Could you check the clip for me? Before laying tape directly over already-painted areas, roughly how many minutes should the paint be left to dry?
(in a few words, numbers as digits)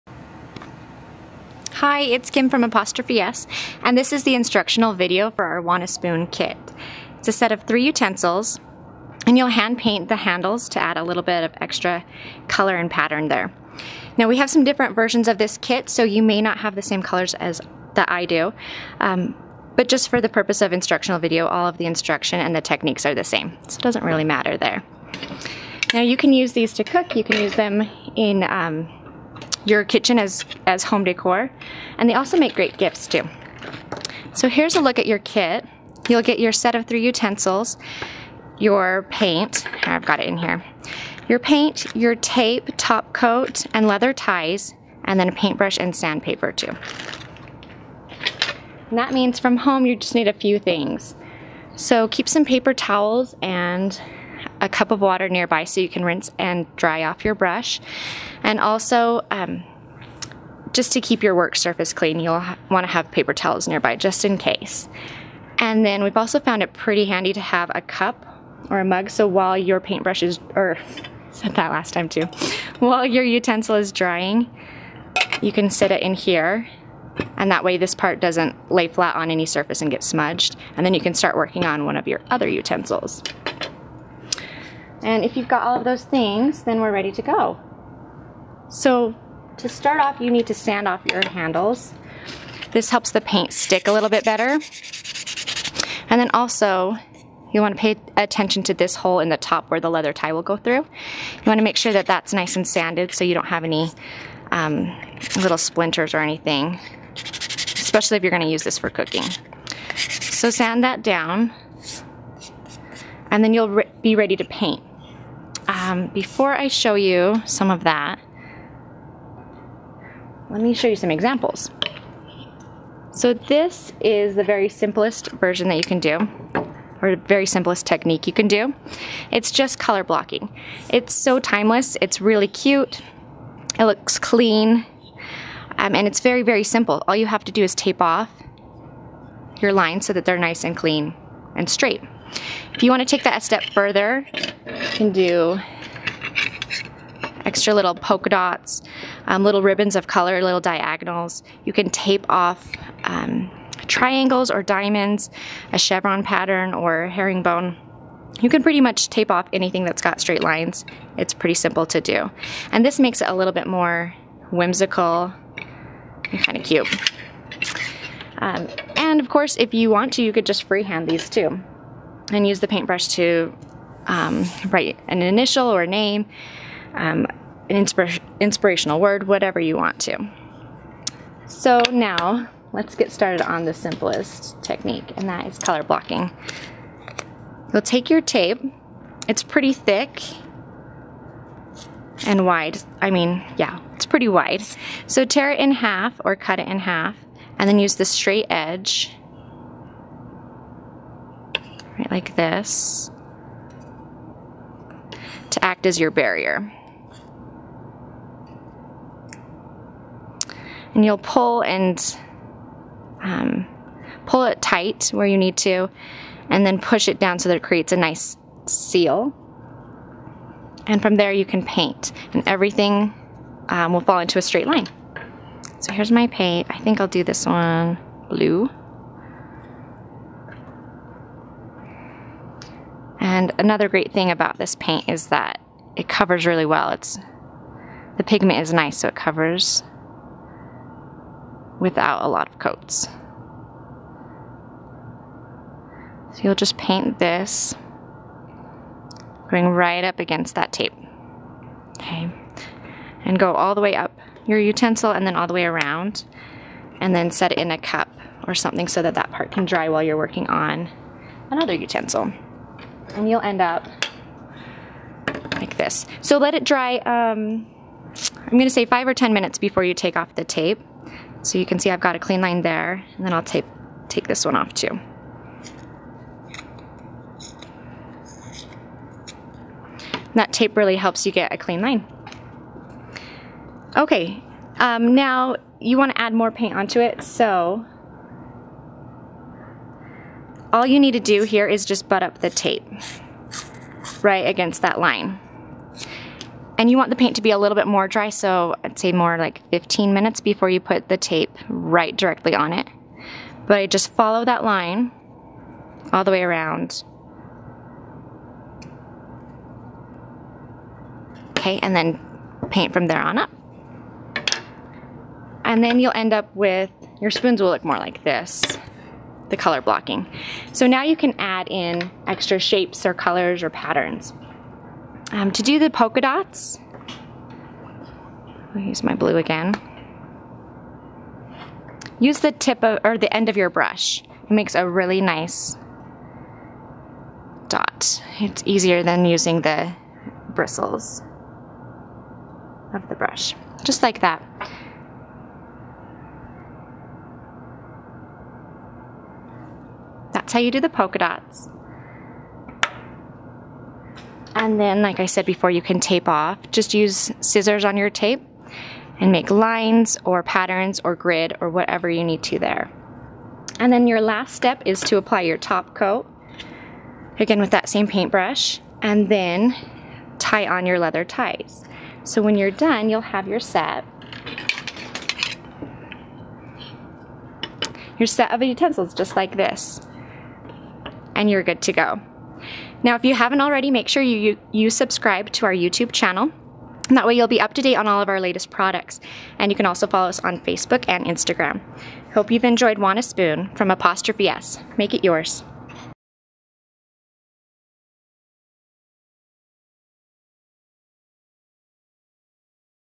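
15 minutes.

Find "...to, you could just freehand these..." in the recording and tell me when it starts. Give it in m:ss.
2:50.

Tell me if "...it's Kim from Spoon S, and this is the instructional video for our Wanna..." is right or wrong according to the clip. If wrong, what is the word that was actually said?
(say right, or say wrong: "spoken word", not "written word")
wrong: "Apostrophe", not "Spoon".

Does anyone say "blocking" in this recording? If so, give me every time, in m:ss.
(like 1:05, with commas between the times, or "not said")
2:10, 3:05, 5:19.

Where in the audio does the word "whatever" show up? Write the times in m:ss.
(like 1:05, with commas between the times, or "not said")
2:59, 6:01.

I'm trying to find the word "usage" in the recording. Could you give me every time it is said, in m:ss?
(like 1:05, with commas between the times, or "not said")
not said.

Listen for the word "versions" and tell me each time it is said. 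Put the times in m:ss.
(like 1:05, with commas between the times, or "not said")
0:14, 2:05.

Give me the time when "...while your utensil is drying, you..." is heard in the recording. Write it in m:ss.
1:12.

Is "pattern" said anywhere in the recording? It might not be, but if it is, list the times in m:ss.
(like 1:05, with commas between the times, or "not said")
0:12, 2:36, 5:23, 6:00.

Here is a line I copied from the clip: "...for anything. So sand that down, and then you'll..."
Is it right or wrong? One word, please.
wrong.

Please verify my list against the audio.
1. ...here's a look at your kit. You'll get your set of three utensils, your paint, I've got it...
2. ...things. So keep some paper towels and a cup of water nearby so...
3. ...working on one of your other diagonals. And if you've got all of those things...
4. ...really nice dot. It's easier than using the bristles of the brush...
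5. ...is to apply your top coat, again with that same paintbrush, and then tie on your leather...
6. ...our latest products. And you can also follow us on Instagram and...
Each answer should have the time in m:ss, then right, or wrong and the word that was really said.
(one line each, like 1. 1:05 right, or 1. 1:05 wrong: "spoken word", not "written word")
1. 0:34 right
2. 0:50 right
3. 1:21 wrong: "utensils", not "diagonals"
4. 5:34 right
5. 6:04 right
6. 6:28 wrong: "Facebook", not "Instagram".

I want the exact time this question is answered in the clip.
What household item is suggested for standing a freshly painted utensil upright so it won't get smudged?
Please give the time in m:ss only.
1:07.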